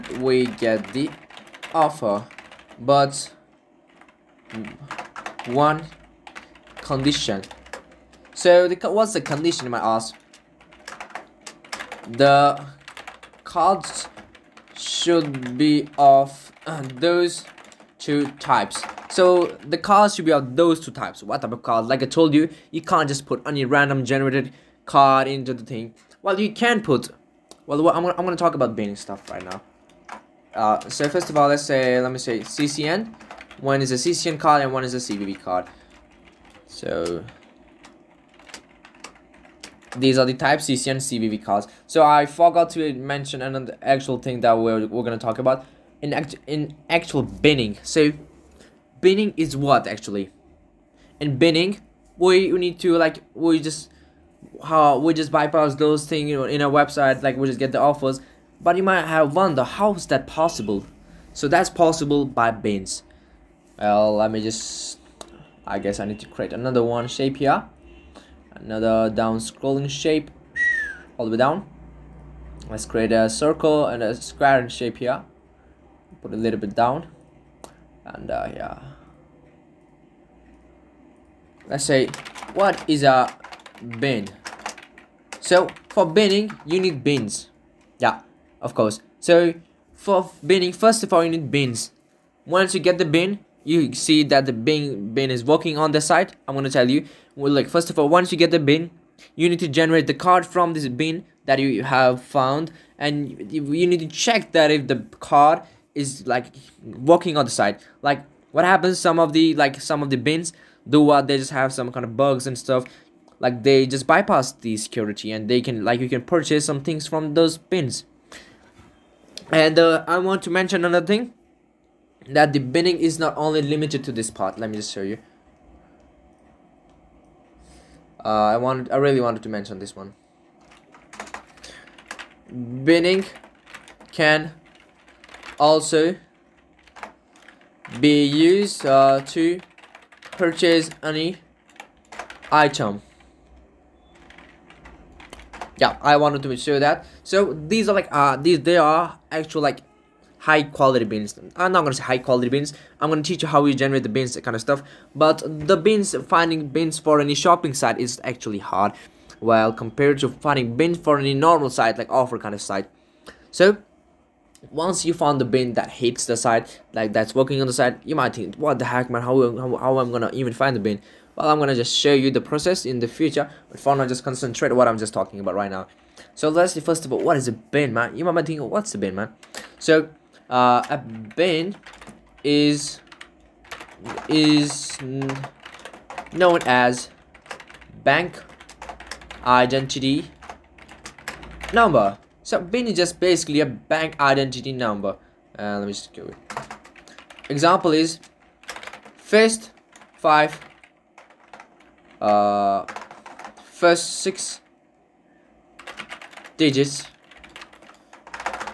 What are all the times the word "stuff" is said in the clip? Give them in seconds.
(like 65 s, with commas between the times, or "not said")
28 s, 112 s, 154 s.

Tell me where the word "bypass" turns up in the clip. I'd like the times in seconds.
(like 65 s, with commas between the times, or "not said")
55 s, 114 s.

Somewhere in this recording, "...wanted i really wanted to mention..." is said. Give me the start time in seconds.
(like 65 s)
128 s.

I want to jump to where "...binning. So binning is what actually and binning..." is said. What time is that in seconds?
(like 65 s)
47 s.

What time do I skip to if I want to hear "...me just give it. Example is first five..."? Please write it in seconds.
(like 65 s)
195 s.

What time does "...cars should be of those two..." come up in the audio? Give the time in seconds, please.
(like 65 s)
19 s.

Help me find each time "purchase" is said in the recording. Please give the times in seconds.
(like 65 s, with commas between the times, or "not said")
116 s, 140 s.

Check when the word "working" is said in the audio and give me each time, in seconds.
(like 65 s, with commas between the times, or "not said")
95 s, 167 s.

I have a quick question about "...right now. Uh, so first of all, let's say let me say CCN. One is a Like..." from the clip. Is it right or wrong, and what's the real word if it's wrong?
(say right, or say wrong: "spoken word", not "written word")
wrong: "CCN", not "Like".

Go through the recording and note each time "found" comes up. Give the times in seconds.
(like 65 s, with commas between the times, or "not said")
102 s, 165 s.